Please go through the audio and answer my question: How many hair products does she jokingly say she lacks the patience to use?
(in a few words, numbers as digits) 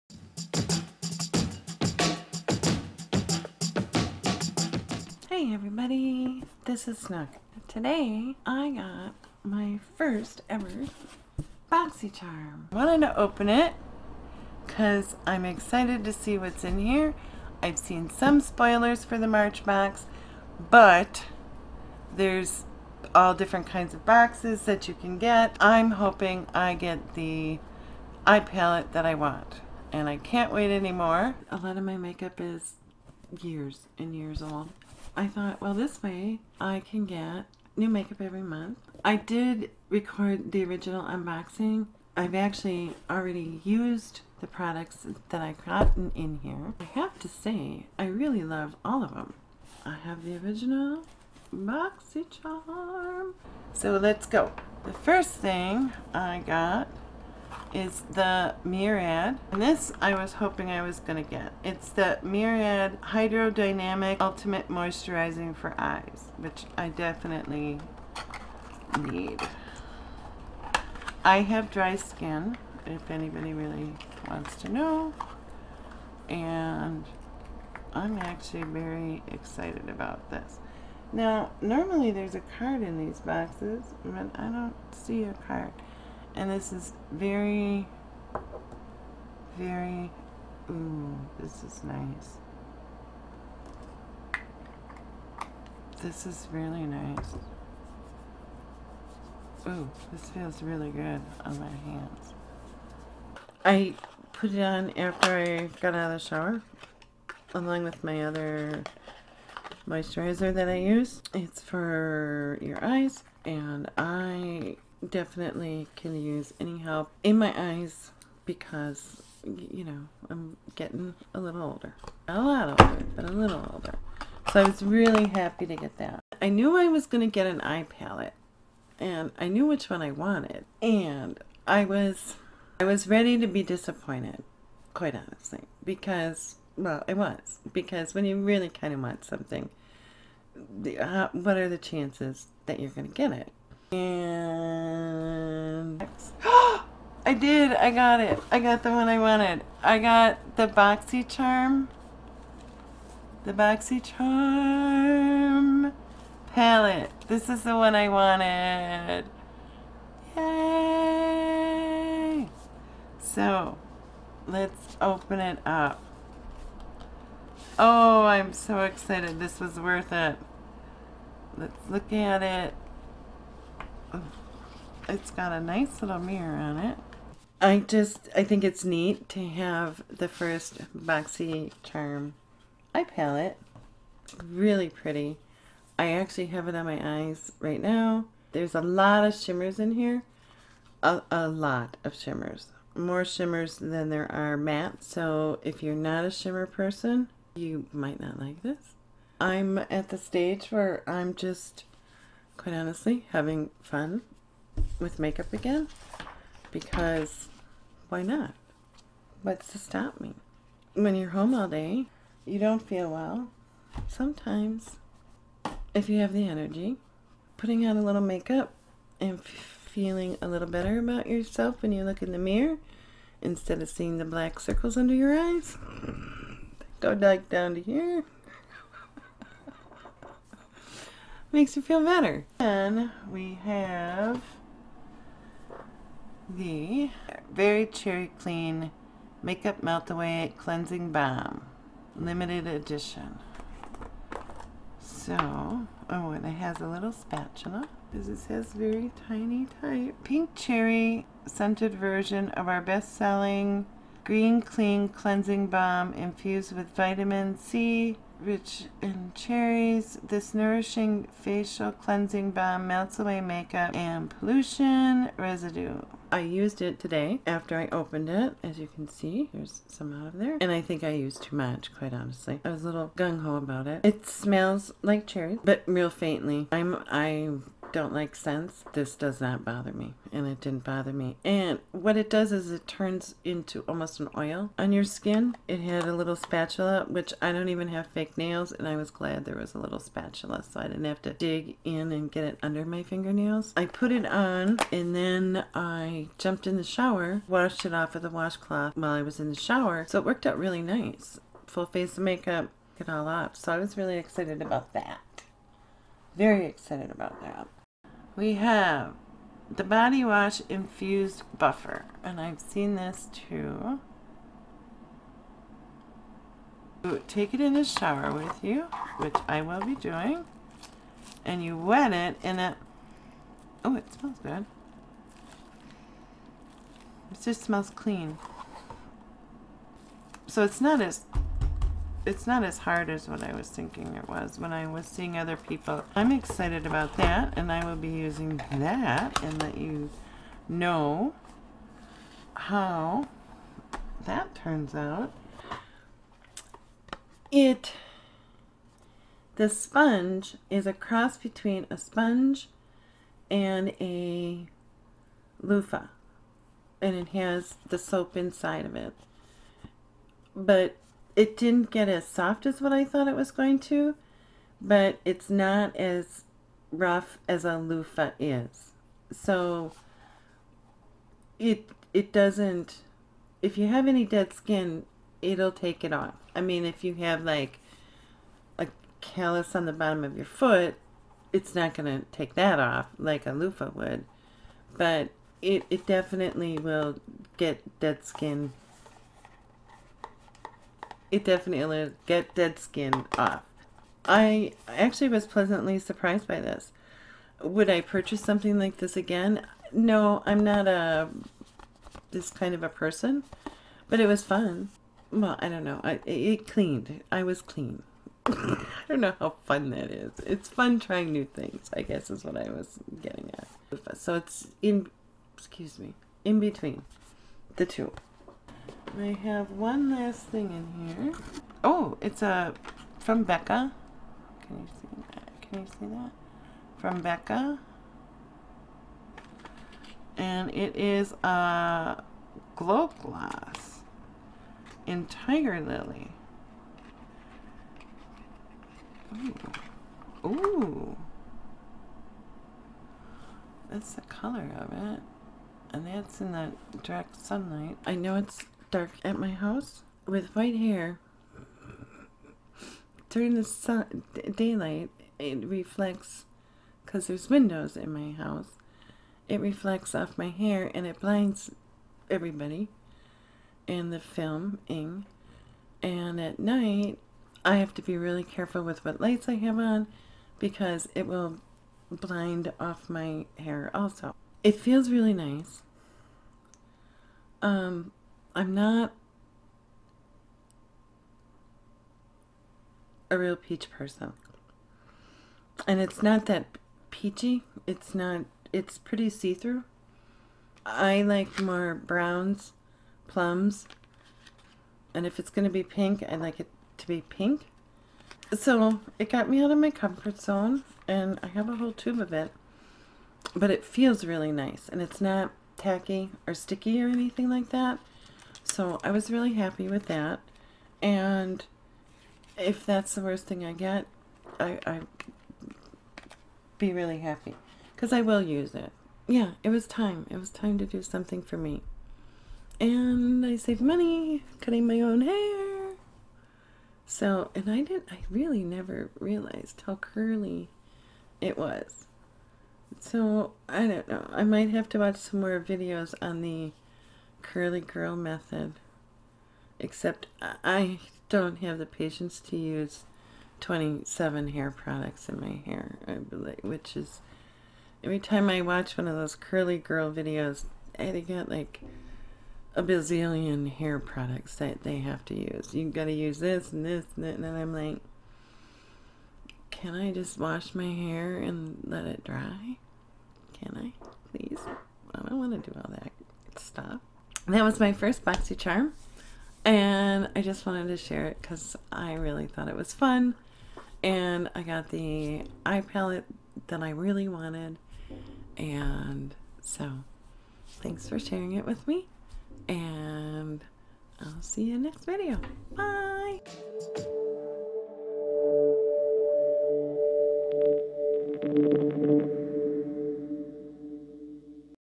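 27.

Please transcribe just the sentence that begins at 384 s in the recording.
But it, it definitely will get dead skin it definitely get dead skin off.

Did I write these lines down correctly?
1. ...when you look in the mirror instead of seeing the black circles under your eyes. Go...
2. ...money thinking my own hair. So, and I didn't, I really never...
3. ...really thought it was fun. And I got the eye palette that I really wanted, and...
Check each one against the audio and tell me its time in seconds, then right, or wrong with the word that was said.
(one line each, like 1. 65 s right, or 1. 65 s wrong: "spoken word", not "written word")
1. 221 s right
2. 523 s wrong: "cutting", not "thinking"
3. 572 s right.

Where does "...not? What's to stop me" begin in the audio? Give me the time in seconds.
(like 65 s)
208 s.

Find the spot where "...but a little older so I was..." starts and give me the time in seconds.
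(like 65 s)
123 s.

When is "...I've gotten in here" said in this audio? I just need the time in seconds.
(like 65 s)
45 s.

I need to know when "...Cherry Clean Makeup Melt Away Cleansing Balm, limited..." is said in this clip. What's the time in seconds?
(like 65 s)
237 s.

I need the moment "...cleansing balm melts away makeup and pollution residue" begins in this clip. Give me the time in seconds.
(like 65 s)
261 s.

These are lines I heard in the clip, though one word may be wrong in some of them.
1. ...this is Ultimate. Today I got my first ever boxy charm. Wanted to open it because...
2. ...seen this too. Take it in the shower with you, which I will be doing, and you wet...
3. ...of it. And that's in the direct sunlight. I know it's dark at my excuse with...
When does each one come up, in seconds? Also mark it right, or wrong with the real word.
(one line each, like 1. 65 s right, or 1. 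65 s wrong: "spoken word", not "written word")
1. 6 s wrong: "Snook", not "Ultimate"
2. 312 s right
3. 444 s wrong: "house", not "excuse".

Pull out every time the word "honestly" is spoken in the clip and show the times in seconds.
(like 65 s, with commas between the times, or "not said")
135 s, 202 s, 272 s.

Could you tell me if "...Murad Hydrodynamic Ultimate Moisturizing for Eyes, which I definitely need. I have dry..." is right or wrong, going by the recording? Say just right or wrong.
right.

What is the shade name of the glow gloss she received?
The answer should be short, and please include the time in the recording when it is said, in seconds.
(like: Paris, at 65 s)
Tiger Lily, at 435 s.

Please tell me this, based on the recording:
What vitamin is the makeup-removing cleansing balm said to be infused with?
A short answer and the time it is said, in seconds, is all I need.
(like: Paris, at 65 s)
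Vitamin C, at 256 s.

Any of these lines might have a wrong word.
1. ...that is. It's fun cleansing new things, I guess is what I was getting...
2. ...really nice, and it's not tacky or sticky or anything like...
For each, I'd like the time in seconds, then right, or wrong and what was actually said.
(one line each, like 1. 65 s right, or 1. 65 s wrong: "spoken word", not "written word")
1. 409 s wrong: "trying", not "cleansing"
2. 504 s right.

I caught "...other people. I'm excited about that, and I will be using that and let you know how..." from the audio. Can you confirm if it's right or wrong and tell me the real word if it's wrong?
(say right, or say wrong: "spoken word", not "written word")
right.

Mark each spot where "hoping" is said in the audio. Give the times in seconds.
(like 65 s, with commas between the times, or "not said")
25 s, 60 s.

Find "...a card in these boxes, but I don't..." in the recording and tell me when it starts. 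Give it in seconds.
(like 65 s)
82 s.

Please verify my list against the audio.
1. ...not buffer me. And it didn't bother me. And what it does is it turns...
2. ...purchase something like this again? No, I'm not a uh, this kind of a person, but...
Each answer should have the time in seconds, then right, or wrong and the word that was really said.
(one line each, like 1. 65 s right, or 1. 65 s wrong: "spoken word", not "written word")
1. 279 s wrong: "bother", not "buffer"
2. 398 s right.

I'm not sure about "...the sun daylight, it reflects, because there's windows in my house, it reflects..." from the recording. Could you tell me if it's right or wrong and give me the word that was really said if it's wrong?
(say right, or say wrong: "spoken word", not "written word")
right.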